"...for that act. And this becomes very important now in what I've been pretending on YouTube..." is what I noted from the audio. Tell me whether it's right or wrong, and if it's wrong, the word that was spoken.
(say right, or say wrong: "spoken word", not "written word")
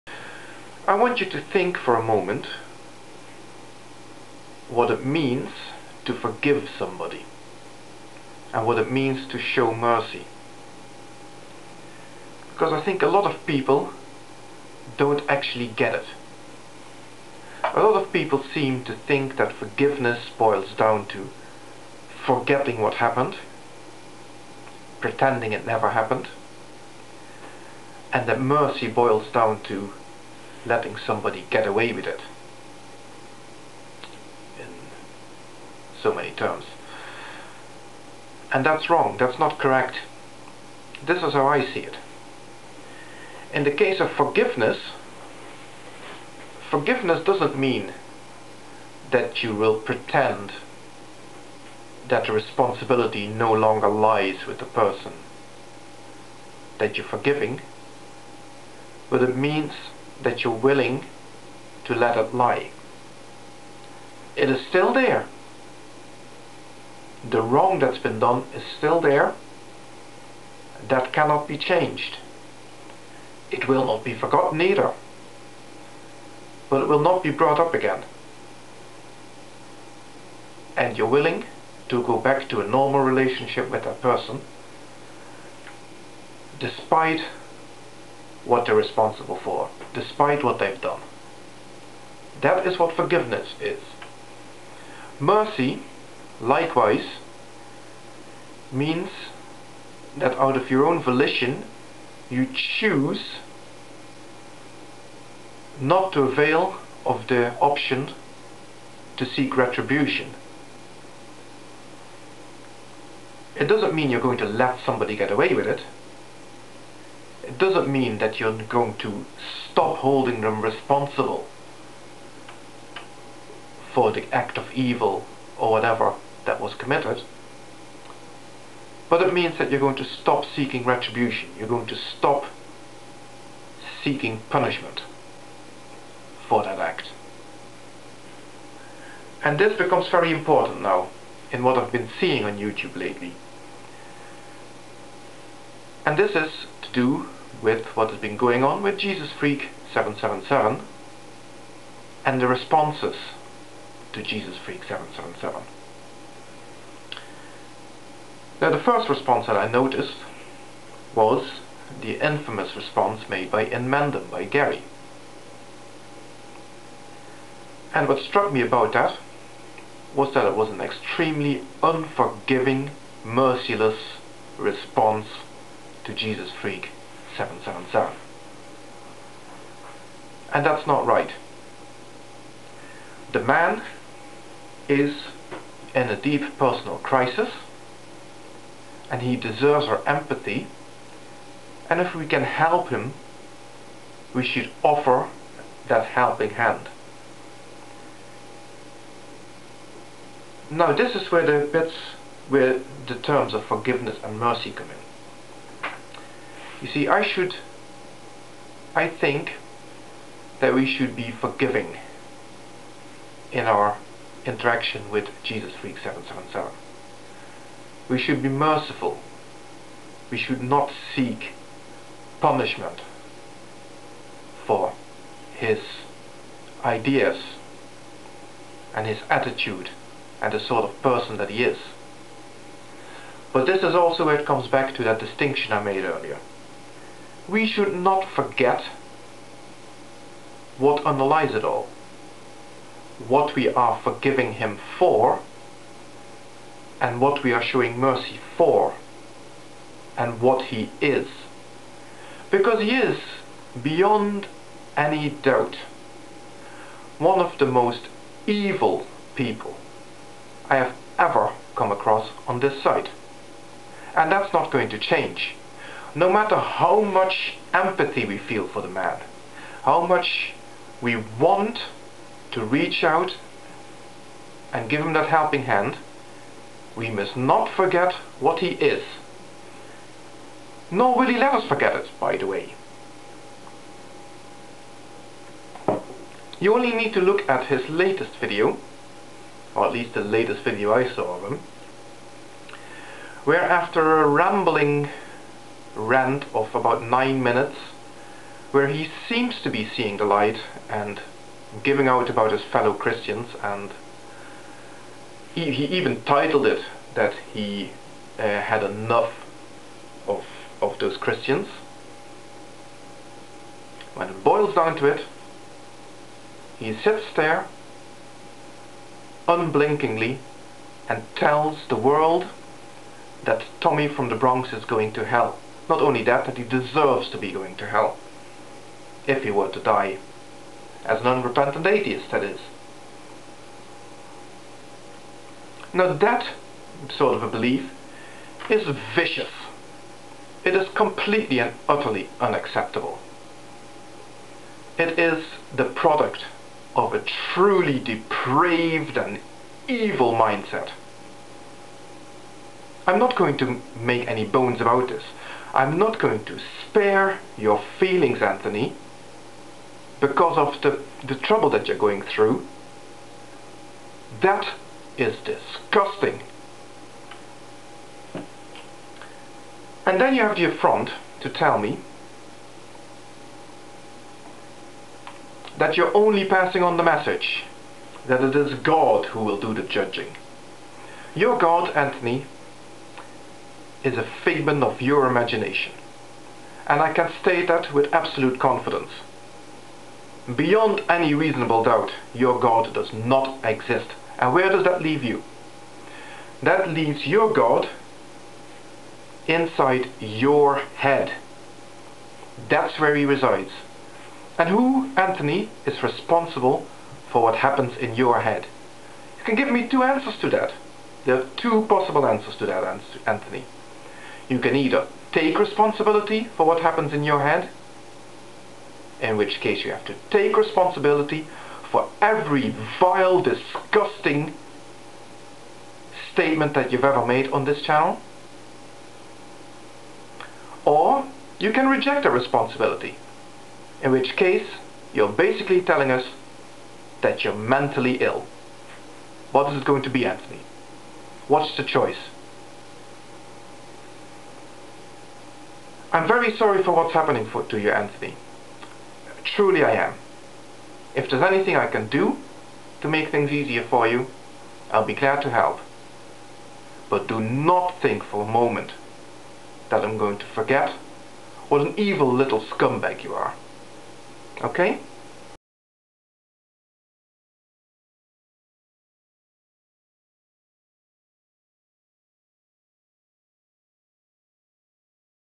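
wrong: "seeing", not "pretending".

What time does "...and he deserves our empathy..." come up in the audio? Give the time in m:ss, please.
3:09.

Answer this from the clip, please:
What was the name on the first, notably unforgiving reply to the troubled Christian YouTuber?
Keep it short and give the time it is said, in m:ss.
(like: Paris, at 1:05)
Gary, at 2:44.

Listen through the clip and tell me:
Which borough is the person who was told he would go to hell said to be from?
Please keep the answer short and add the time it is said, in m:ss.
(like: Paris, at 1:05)
The Bronx, at 5:24.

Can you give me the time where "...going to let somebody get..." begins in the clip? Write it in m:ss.
1:54.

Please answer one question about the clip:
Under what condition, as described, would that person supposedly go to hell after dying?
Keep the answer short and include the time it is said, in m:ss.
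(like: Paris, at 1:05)
As an unrepentant atheist, at 5:31.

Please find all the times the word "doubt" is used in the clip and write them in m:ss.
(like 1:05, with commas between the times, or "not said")
4:15, 6:31.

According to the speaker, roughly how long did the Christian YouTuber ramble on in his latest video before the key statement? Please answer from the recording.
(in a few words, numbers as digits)
About 9 minutes.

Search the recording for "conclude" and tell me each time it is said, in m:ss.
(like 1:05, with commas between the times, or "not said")
not said.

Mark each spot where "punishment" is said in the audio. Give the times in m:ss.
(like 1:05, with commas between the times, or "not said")
2:14, 3:42.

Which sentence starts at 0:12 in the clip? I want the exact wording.
Because I think a lot of people don't actually get it.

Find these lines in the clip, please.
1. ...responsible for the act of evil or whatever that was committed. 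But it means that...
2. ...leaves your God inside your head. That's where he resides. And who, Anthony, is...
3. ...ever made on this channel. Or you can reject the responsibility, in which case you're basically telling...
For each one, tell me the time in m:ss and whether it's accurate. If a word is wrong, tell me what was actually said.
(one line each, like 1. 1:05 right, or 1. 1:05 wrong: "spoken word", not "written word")
1. 2:00 right
2. 6:36 right
3. 7:07 right.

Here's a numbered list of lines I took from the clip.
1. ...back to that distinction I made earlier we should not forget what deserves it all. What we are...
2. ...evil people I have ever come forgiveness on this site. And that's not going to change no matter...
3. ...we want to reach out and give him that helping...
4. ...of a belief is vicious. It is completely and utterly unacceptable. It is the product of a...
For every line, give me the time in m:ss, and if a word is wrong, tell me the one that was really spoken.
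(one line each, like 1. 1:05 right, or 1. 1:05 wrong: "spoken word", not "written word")
1. 3:54 wrong: "underlies", not "deserves"
2. 4:18 wrong: "across", not "forgiveness"
3. 4:31 right
4. 5:37 right.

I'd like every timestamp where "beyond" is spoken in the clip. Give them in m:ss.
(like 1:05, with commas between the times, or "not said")
4:13, 6:30.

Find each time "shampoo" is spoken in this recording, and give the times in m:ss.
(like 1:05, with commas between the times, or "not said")
not said.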